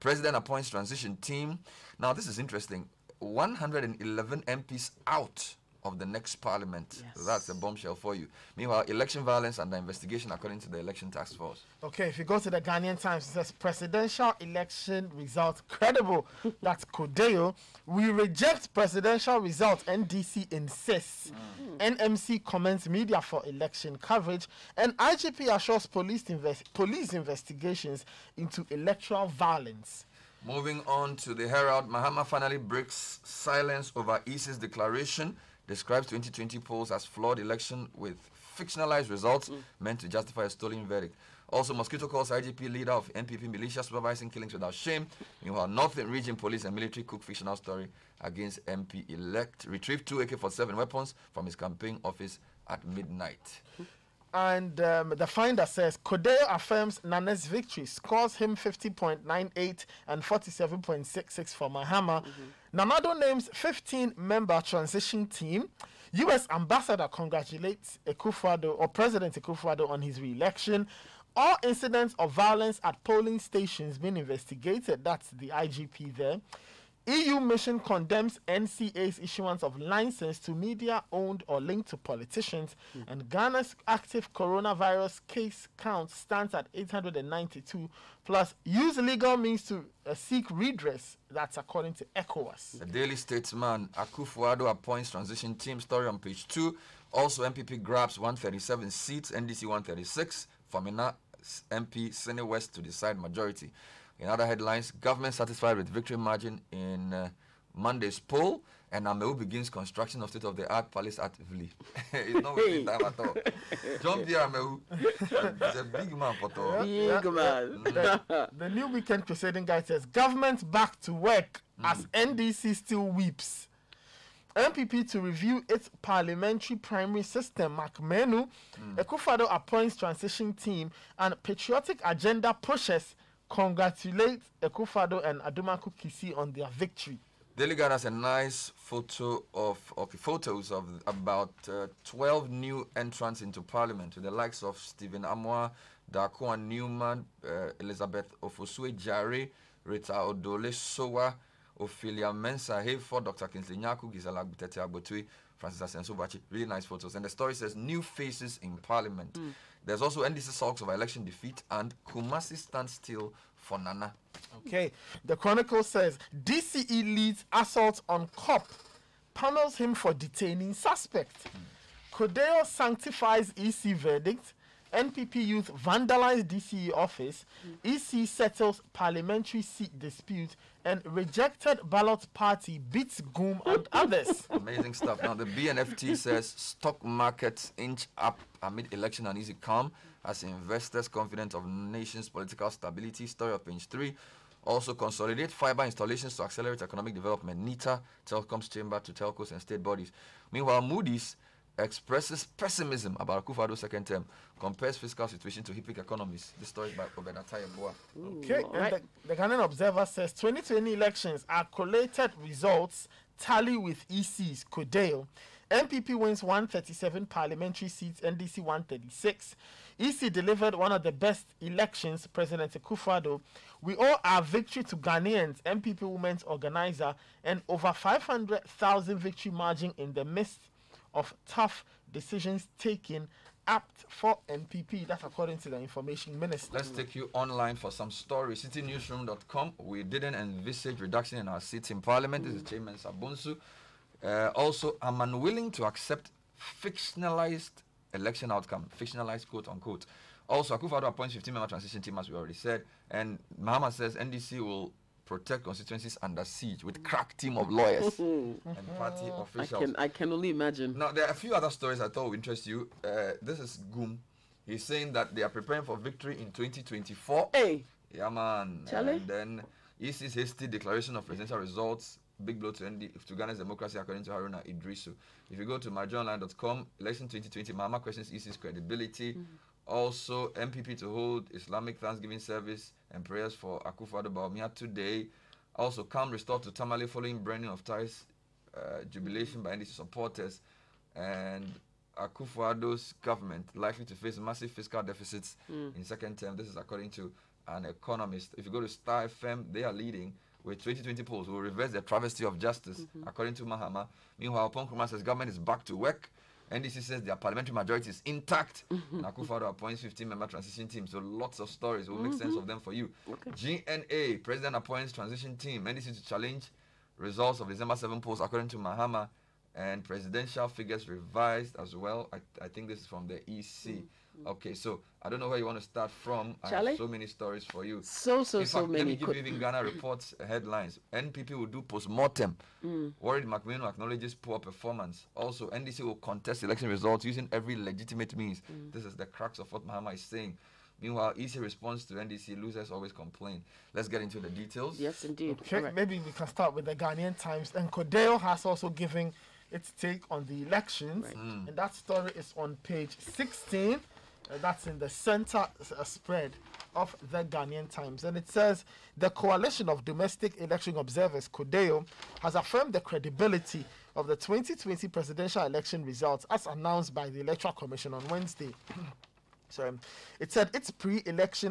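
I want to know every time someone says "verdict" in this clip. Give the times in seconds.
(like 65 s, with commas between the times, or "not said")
40 s, 173 s.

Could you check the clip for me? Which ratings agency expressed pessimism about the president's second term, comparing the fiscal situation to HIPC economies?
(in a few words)
Moody's.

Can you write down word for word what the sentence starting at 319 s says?
And presidential figures revised as well.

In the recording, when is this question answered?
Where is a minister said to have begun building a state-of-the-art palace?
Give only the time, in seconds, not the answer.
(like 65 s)
111 s.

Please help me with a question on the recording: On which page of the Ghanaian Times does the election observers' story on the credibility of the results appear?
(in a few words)
16.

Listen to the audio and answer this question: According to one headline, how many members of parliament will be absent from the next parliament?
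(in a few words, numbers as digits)
111.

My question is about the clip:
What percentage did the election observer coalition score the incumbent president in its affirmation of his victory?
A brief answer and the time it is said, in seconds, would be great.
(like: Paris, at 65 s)
50.98, at 58 s.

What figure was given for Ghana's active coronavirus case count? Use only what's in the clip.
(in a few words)
892.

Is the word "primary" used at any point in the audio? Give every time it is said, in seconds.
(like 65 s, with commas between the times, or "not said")
126 s.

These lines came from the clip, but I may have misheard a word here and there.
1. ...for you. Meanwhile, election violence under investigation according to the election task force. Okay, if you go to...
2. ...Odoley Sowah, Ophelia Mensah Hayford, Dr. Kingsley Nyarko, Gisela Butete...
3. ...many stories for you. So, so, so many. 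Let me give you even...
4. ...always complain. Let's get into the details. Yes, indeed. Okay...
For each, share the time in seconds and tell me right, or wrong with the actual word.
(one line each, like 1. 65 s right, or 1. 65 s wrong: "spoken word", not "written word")
1. 7 s right
2. 150 s right
3. 327 s right
4. 342 s right.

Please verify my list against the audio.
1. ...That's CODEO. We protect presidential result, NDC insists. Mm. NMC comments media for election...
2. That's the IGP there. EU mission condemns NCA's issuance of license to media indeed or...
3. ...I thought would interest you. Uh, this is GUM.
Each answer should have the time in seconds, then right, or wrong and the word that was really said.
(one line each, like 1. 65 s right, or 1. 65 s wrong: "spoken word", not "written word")
1. 16 s wrong: "reject", not "protect"
2. 75 s wrong: "owned", not "indeed"
3. 262 s right.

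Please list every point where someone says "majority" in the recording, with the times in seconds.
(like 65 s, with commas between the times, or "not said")
103 s, 307 s.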